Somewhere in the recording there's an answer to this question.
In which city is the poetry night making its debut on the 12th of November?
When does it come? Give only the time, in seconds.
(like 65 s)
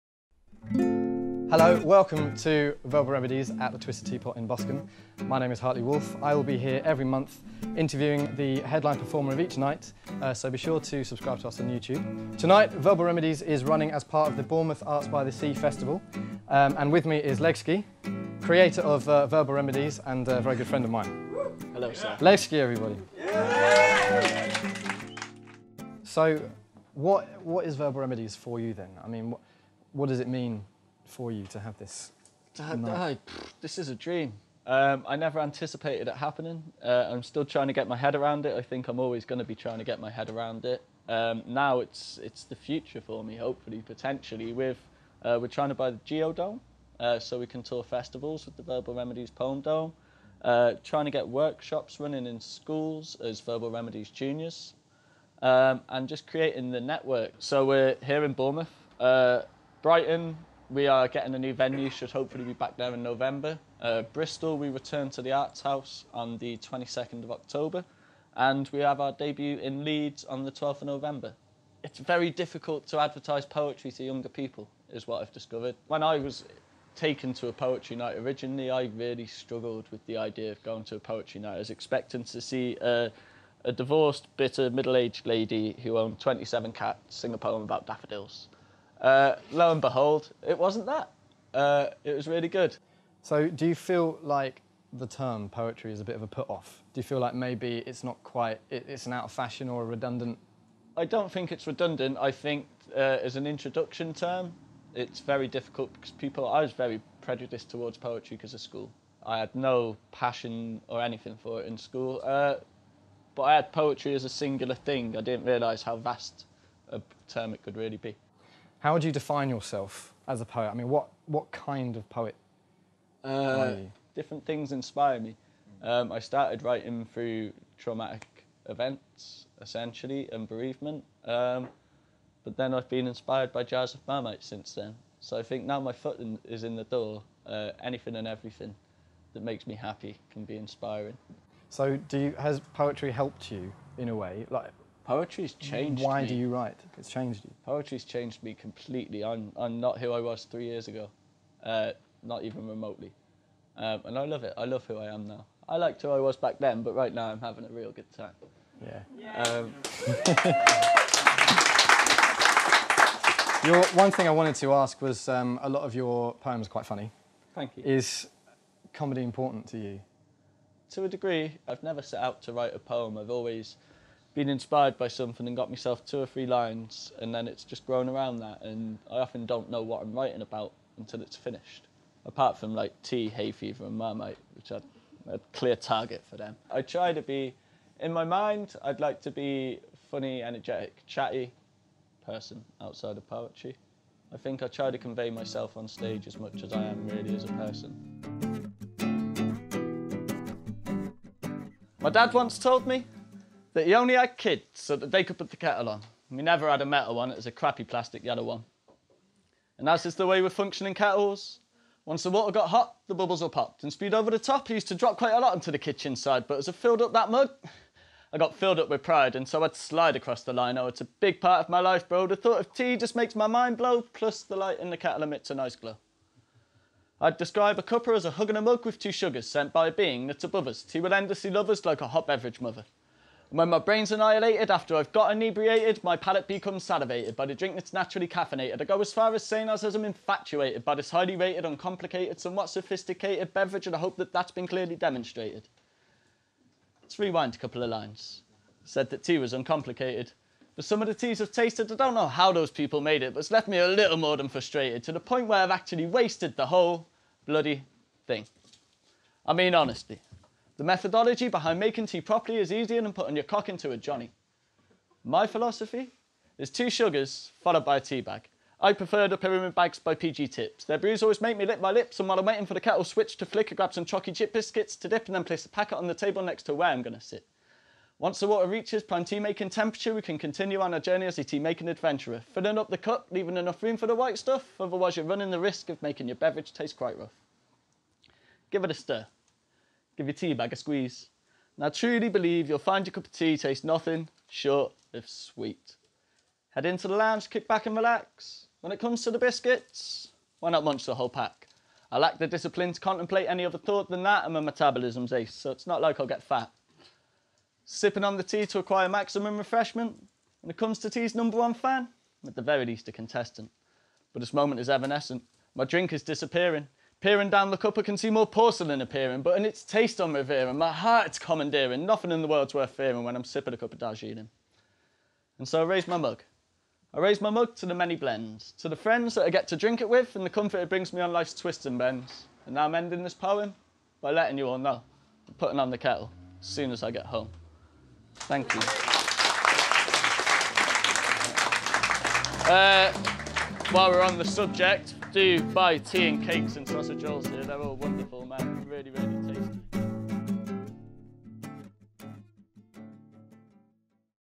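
69 s.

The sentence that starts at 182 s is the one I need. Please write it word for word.
Apart from like tea, hay fever, and marmite, which I a clear target for them.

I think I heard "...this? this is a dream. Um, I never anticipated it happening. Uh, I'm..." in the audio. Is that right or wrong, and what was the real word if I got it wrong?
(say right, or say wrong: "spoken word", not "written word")
right.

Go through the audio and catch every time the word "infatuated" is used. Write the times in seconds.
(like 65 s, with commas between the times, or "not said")
240 s.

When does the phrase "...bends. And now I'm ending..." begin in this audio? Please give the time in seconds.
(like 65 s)
331 s.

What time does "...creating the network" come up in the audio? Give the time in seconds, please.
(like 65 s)
56 s.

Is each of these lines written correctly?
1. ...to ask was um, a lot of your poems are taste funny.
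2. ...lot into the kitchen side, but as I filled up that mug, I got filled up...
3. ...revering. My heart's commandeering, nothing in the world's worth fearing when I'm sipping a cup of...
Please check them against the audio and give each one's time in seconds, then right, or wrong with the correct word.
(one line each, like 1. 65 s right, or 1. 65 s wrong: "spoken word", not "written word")
1. 164 s wrong: "quite", not "taste"
2. 215 s right
3. 320 s right.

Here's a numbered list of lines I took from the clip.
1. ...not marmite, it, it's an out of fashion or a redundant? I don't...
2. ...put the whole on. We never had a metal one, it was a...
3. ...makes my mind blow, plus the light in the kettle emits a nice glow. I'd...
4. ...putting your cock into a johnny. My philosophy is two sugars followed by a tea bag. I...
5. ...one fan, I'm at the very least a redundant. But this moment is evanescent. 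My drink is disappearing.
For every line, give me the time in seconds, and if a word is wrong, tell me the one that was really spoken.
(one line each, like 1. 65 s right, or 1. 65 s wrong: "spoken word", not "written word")
1. 98 s wrong: "quite", not "marmite"
2. 205 s wrong: "kettle", not "whole"
3. 223 s right
4. 263 s right
5. 311 s wrong: "contestant", not "redundant".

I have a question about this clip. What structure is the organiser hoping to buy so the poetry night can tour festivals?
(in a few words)
The Geodome.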